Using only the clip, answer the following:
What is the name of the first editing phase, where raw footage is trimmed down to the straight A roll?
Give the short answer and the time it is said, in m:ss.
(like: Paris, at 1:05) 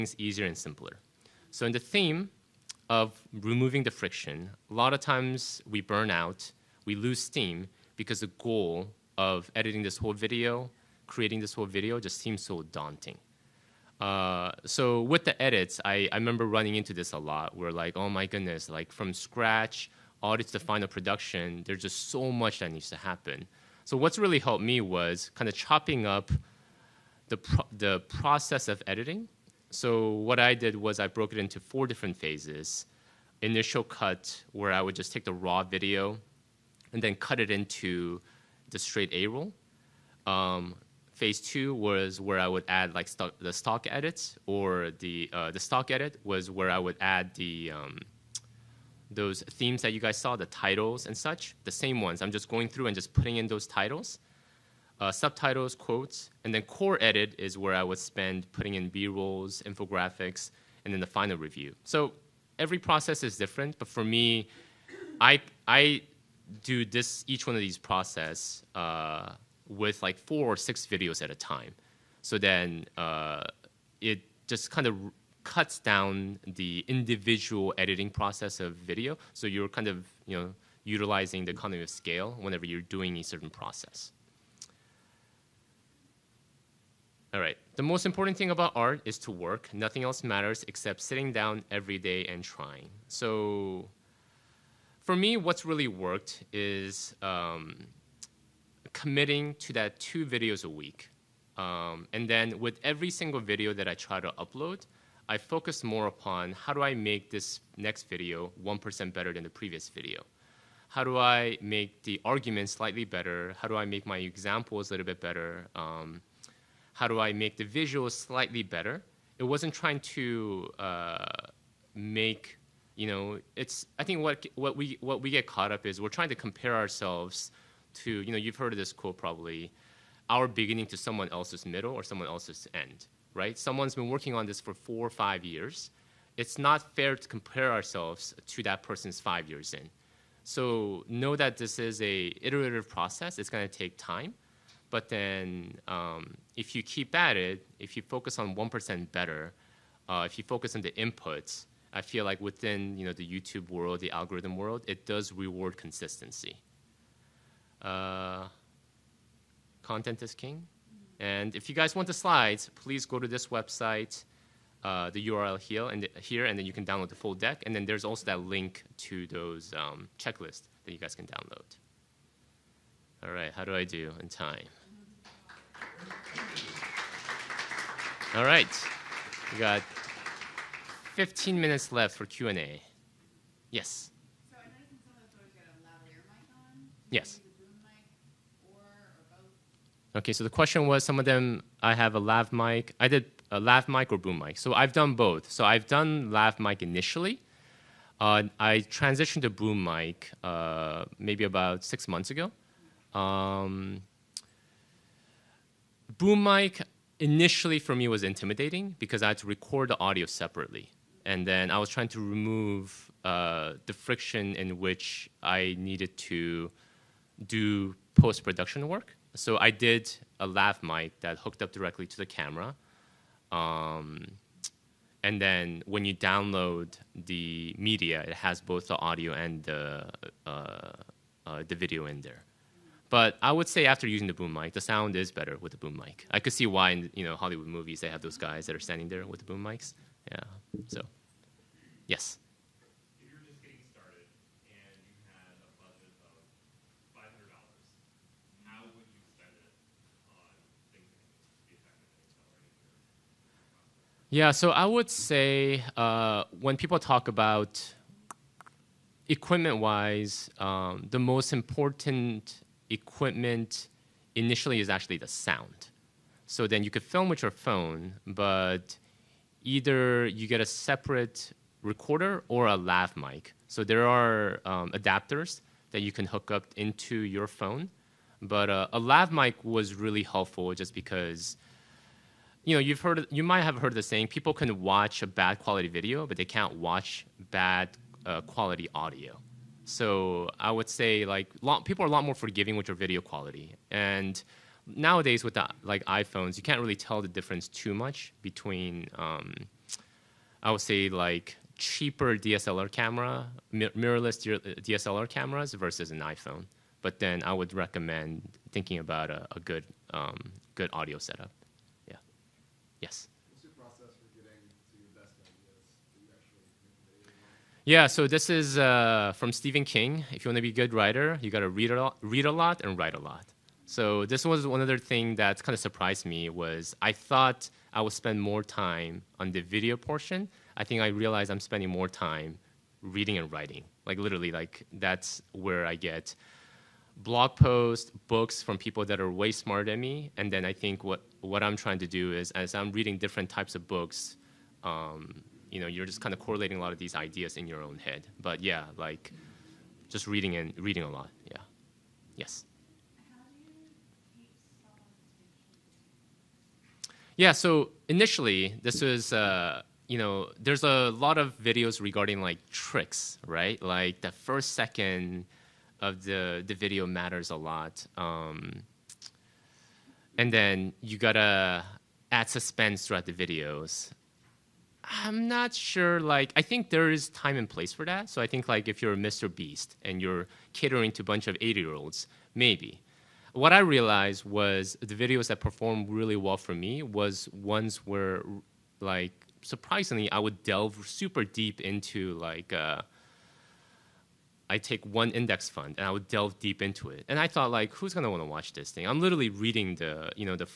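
Initial cut, at 0:33.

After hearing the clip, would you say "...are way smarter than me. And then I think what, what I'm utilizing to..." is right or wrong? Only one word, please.
wrong.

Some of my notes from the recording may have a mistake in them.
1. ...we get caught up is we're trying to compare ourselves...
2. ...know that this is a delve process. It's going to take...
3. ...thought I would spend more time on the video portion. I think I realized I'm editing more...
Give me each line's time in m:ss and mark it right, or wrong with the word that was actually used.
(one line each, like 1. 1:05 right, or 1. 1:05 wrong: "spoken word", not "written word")
1. 2:05 right
2. 2:21 wrong: "iterative", not "delve"
3. 5:27 wrong: "spending", not "editing".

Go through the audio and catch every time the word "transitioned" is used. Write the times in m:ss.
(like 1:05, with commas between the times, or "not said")
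3:18.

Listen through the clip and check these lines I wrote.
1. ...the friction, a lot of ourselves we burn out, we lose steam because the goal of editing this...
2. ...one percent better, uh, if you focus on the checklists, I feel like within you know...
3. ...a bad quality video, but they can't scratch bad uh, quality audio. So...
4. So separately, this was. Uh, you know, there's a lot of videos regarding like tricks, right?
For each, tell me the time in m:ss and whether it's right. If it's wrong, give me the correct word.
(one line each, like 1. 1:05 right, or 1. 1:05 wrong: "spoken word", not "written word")
1. 0:03 wrong: "times", not "ourselves"
2. 2:28 wrong: "inputs", not "checklists"
3. 4:45 wrong: "watch", not "scratch"
4. 5:57 wrong: "initially", not "separately".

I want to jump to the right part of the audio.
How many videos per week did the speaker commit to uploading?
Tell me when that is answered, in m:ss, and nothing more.
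1:39.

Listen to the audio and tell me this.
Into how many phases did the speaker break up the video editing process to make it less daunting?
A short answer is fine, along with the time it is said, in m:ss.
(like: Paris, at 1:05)
4, at 0:31.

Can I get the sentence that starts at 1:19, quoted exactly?
So you're kind of you know utilizing the economy of scale whenever you're doing a certain process.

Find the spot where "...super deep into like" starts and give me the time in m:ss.
6:31.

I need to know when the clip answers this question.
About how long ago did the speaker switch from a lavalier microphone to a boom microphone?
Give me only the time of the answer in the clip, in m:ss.
3:21.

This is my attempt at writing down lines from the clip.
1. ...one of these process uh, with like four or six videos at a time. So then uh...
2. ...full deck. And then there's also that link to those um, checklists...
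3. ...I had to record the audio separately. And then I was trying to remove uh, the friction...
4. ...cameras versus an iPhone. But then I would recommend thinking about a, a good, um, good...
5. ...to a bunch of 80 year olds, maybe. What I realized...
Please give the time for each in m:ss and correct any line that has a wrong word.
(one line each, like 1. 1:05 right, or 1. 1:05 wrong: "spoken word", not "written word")
1. 1:07 right
2. 2:47 right
3. 3:29 right
4. 5:05 right
5. 6:21 right.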